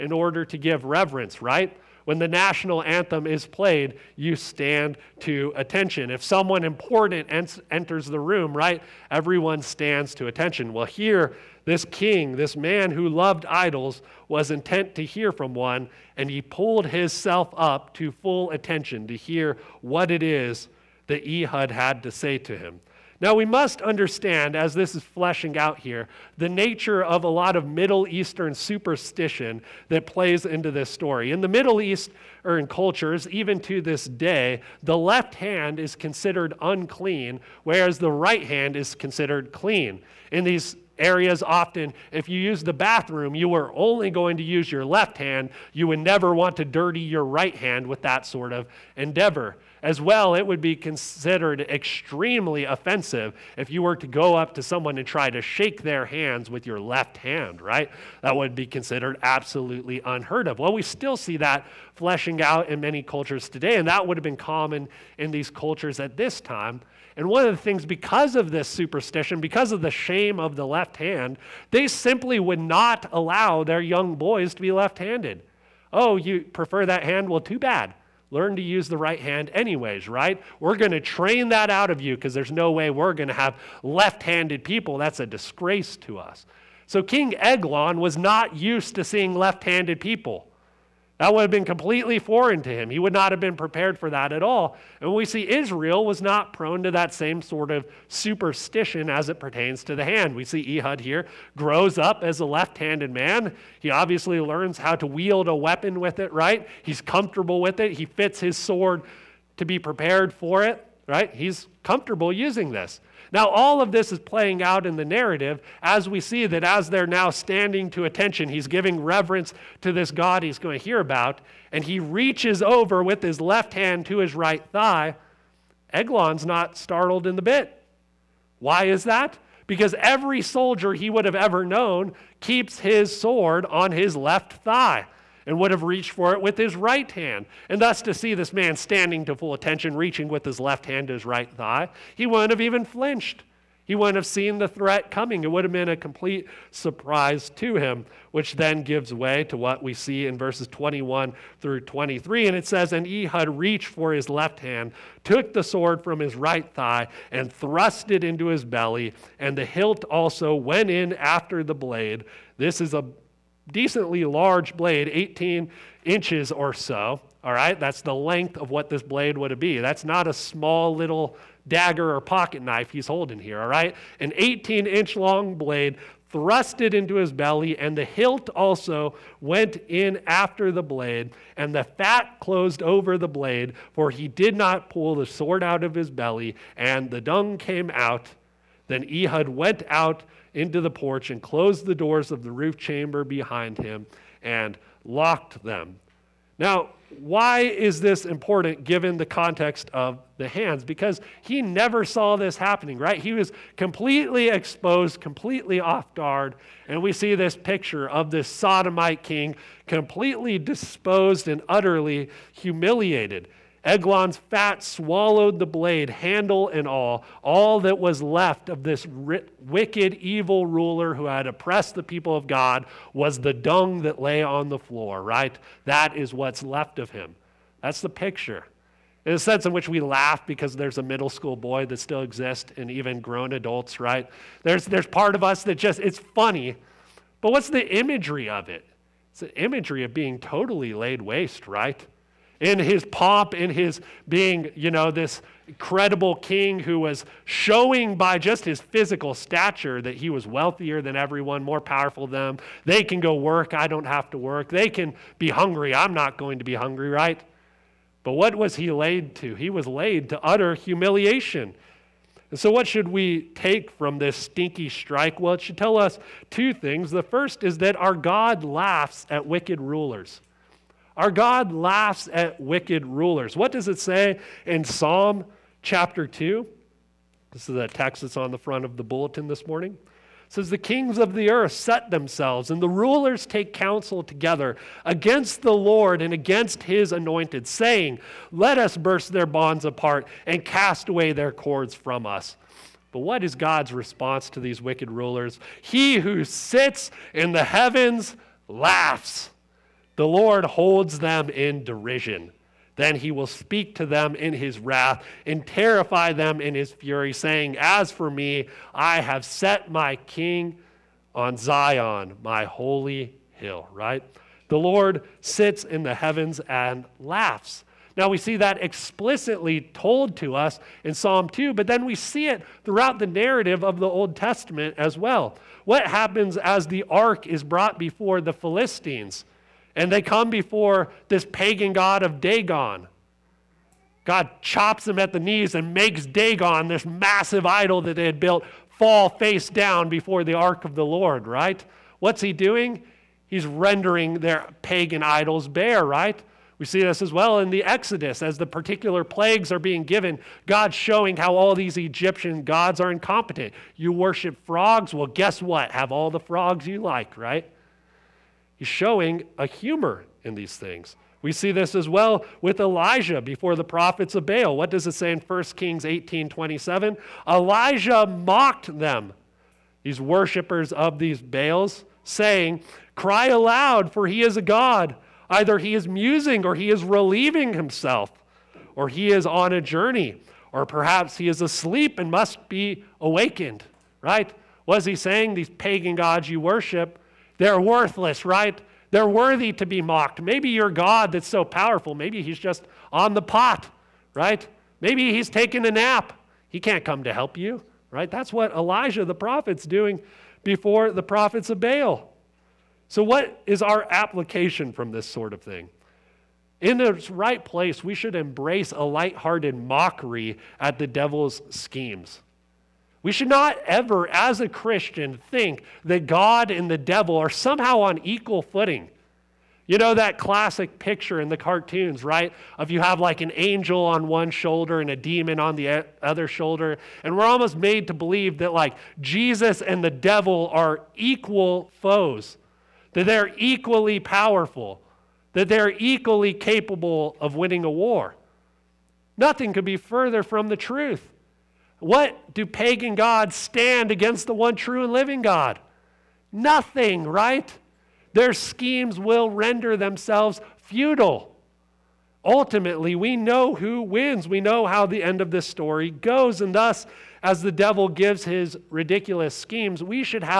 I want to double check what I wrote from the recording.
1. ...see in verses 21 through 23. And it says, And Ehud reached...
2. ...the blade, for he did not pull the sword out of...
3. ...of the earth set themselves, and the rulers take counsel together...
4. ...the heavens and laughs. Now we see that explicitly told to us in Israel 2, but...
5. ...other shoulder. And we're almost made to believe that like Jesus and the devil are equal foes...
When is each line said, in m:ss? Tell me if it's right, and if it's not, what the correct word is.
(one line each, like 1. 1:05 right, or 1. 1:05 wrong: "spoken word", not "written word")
1. 2:29 right
2. 3:03 right
3. 4:41 right
4. 5:16 wrong: "Psalm", not "Israel"
5. 7:06 right.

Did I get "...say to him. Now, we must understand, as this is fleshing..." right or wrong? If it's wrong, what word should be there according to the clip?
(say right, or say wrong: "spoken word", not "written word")
right.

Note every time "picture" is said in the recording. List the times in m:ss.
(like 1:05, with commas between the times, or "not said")
3:27, 3:48, 7:00.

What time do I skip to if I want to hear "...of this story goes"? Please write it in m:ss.
7:35.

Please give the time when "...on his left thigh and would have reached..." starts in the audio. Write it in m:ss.
2:13.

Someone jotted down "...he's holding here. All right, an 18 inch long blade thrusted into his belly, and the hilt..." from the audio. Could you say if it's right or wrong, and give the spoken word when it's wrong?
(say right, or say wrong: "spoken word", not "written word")
right.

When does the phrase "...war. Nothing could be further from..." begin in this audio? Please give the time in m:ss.
7:17.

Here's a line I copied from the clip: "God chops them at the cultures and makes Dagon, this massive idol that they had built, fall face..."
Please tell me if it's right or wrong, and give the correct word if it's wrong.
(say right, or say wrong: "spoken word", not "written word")
wrong: "knees", not "cultures".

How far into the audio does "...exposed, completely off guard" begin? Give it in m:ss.
3:24.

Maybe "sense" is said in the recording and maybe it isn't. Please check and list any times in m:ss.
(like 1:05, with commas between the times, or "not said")
3:49.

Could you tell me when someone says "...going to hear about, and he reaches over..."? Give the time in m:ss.
2:00.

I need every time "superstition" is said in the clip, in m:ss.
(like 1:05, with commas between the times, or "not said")
0:28, 1:08, 1:38.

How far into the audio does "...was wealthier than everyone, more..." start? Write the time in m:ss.
4:10.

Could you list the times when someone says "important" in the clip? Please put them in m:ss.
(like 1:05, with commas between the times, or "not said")
0:06, 3:18.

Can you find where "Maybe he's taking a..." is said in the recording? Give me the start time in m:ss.
6:35.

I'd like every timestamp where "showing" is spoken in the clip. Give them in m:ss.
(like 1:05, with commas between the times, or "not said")
4:07, 5:50, 5:58.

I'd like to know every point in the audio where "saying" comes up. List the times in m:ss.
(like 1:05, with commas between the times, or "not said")
4:47, 5:07, 6:12, 6:25.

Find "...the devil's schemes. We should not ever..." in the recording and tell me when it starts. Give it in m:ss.
6:50.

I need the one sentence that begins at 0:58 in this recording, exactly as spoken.
That would be considered absolutely unheard of.